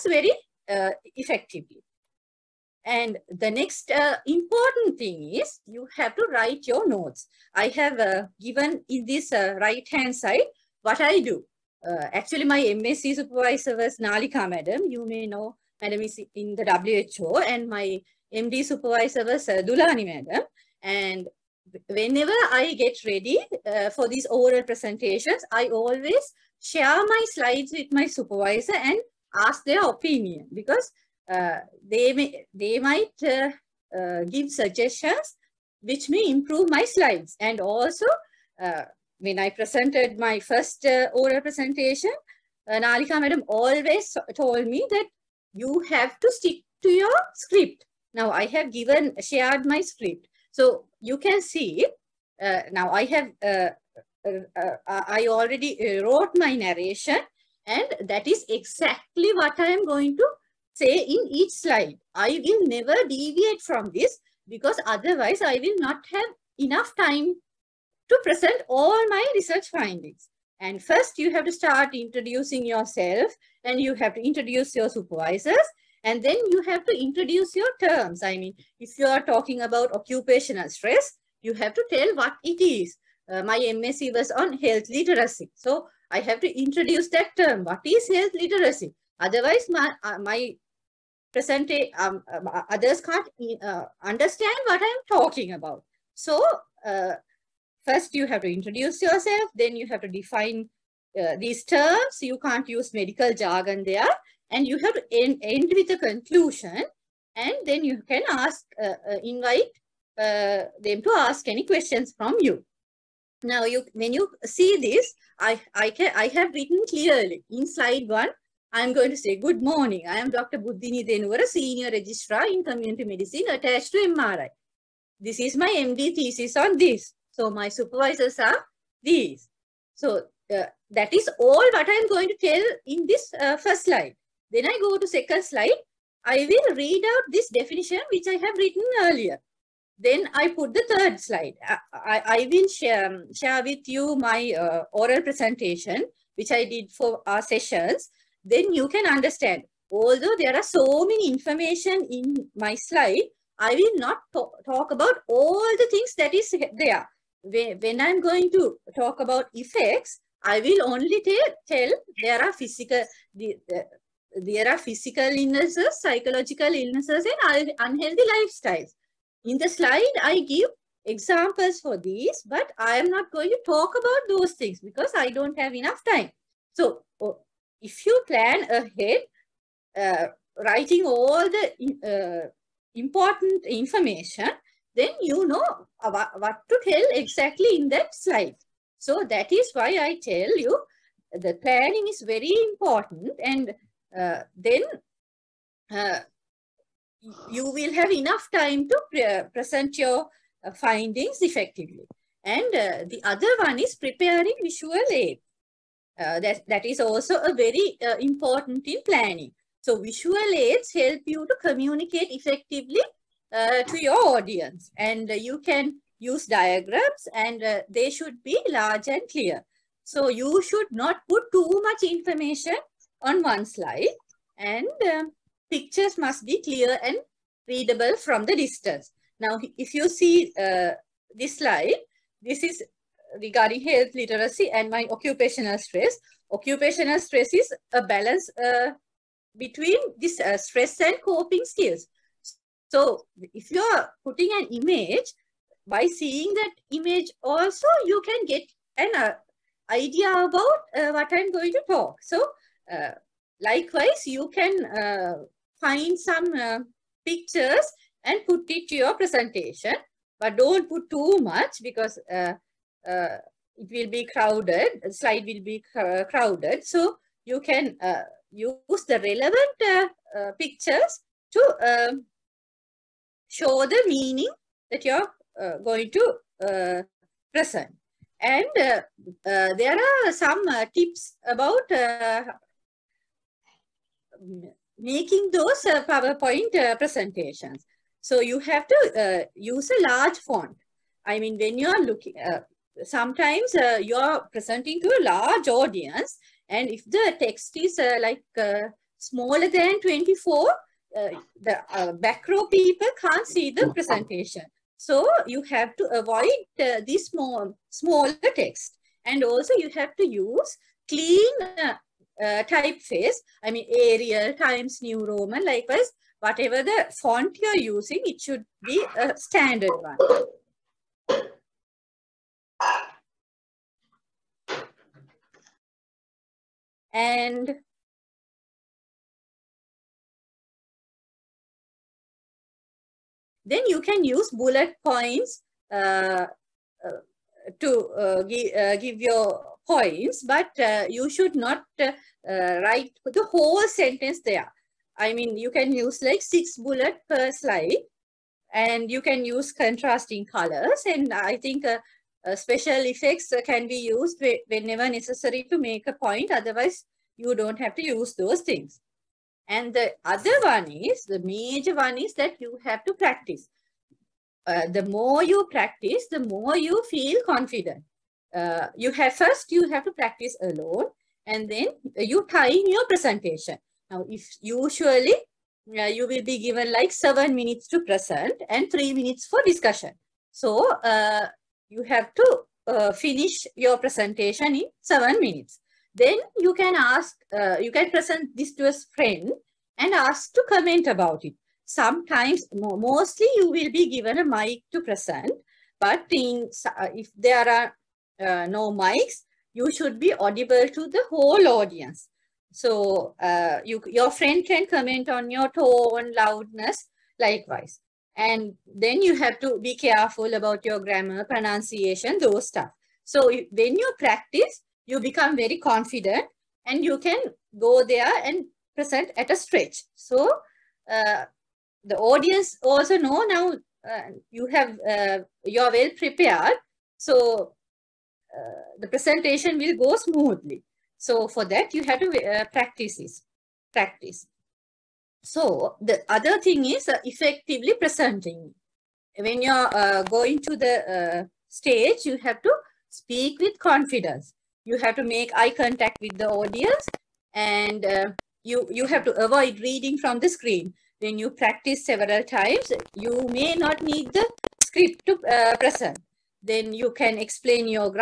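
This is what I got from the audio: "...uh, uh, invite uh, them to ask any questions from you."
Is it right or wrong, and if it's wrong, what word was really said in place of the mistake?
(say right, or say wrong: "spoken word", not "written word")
right.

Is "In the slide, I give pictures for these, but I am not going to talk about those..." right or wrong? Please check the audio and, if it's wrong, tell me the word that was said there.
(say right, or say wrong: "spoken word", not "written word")
wrong: "examples", not "pictures".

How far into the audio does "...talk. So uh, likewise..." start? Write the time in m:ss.
4:11.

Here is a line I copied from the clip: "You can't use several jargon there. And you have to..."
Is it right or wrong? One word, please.
wrong.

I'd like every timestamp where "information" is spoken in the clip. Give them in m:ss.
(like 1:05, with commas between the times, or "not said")
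2:31, 3:03, 3:42.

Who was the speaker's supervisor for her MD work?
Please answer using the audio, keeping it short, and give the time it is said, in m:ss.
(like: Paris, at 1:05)
Dulani madam, at 0:19.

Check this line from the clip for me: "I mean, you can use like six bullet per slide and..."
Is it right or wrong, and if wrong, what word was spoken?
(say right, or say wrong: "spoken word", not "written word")
right.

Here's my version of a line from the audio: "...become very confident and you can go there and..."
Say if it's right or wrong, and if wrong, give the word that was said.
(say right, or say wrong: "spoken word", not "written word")
right.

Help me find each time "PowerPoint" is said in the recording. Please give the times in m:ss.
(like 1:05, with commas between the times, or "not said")
4:46.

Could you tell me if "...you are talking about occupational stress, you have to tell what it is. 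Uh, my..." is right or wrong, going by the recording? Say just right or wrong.
right.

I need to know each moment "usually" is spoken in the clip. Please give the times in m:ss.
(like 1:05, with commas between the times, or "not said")
6:14.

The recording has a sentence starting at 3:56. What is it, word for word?
Occupational stress is a balance uh, between this uh, stress and coping skills.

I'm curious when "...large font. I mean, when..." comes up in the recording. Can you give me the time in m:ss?
4:50.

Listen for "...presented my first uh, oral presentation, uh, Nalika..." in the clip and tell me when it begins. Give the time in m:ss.
0:39.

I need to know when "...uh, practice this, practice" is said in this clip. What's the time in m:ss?
7:12.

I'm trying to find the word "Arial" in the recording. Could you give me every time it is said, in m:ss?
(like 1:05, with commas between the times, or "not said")
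5:13.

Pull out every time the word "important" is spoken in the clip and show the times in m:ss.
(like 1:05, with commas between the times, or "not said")
0:04, 3:02, 3:12, 3:28.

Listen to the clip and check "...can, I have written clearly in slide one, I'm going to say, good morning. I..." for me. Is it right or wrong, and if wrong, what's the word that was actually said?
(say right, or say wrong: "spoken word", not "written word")
right.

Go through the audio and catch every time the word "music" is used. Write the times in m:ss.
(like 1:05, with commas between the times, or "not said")
not said.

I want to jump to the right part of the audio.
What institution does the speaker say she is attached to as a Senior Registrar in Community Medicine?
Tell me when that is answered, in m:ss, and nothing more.
2:03.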